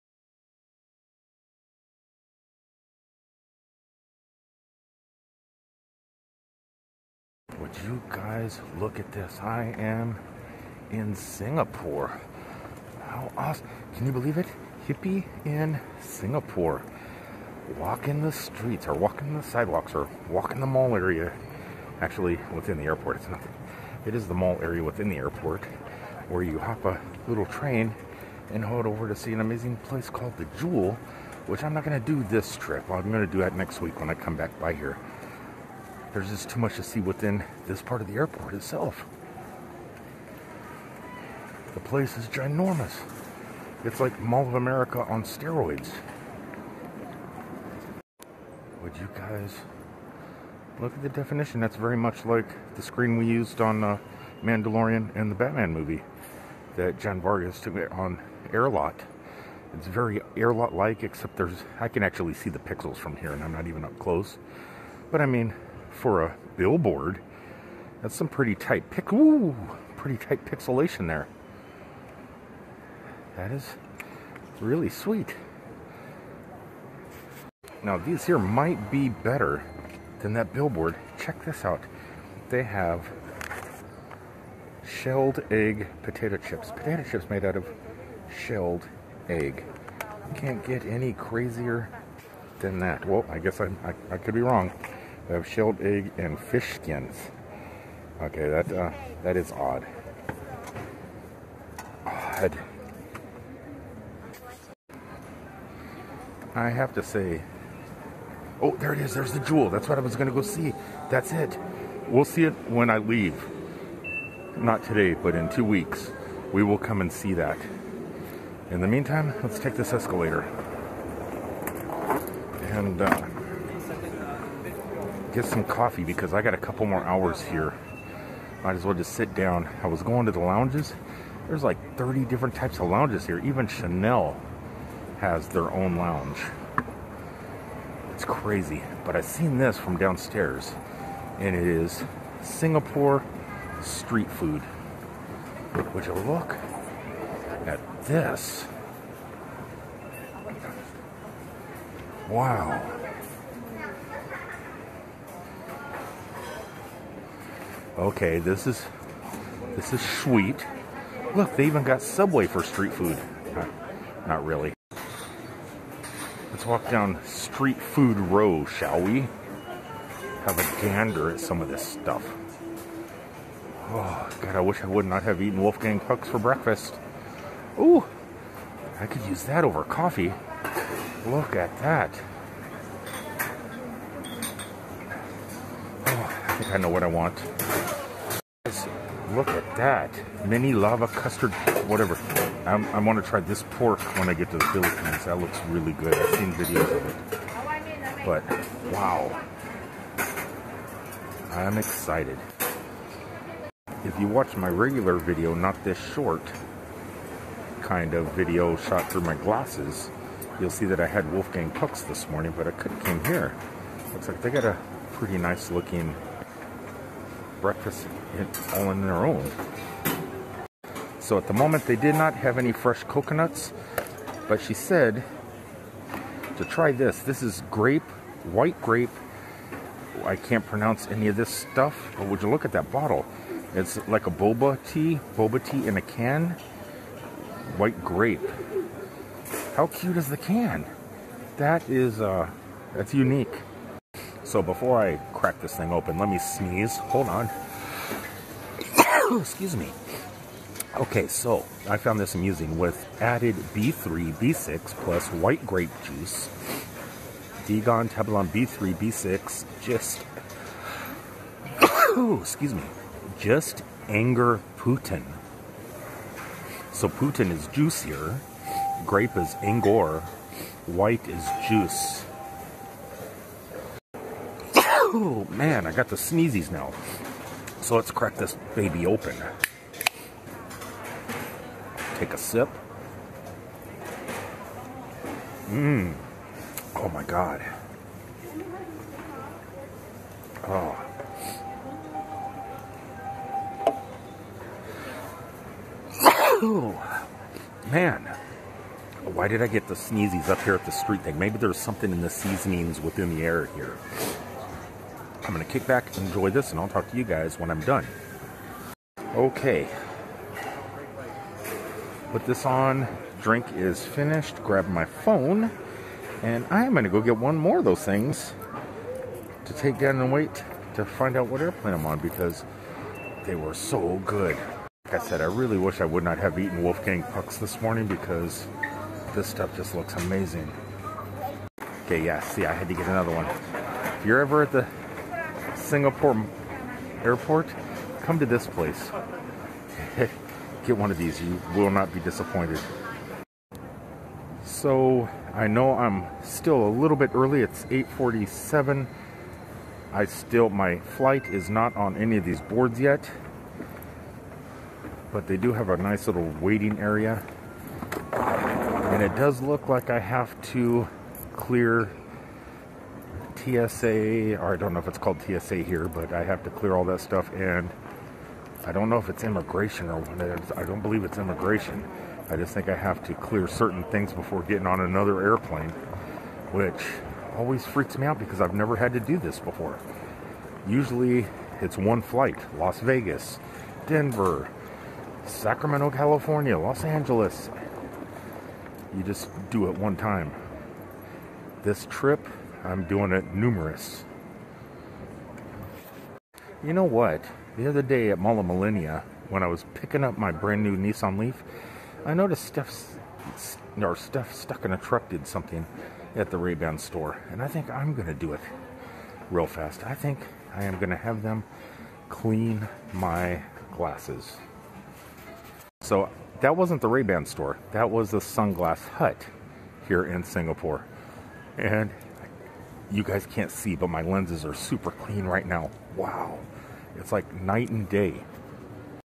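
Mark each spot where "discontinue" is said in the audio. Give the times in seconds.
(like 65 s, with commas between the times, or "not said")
not said.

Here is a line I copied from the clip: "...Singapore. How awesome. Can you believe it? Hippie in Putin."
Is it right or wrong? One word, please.
wrong.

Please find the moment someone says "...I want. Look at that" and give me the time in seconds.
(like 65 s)
187 s.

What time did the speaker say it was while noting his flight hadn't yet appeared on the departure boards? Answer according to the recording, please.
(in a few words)
8:47.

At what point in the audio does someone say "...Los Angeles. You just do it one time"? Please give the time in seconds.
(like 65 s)
386 s.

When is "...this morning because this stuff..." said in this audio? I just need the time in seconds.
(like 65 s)
327 s.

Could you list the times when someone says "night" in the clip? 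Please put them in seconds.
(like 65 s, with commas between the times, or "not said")
427 s.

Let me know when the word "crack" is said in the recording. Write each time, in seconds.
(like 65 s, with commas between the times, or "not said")
245 s, 278 s.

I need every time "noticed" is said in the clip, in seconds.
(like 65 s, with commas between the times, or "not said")
402 s.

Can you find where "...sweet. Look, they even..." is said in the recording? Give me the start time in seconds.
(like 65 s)
160 s.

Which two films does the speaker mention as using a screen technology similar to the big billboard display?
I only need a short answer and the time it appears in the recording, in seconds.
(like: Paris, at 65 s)
Mandalorian and the Batman, at 54 s.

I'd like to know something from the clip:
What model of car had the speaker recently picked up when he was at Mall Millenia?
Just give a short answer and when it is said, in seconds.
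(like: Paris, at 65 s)
Nissan Leaf, at 400 s.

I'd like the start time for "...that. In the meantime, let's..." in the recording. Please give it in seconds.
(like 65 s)
117 s.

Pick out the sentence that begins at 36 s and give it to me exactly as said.
There's just too much to see within this part of the airport itself.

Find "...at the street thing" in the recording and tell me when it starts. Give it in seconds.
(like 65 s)
300 s.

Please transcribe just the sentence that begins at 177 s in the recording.
Ooh, I could use that over coffee.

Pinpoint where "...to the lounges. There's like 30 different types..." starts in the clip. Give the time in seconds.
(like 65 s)
130 s.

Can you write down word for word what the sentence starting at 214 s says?
Looks like they got a pretty nice looking breakfast all on their own.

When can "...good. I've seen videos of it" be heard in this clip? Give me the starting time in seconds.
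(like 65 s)
195 s.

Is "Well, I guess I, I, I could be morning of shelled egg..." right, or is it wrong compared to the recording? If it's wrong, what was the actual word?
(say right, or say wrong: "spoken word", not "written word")
wrong: "wrong", not "morning".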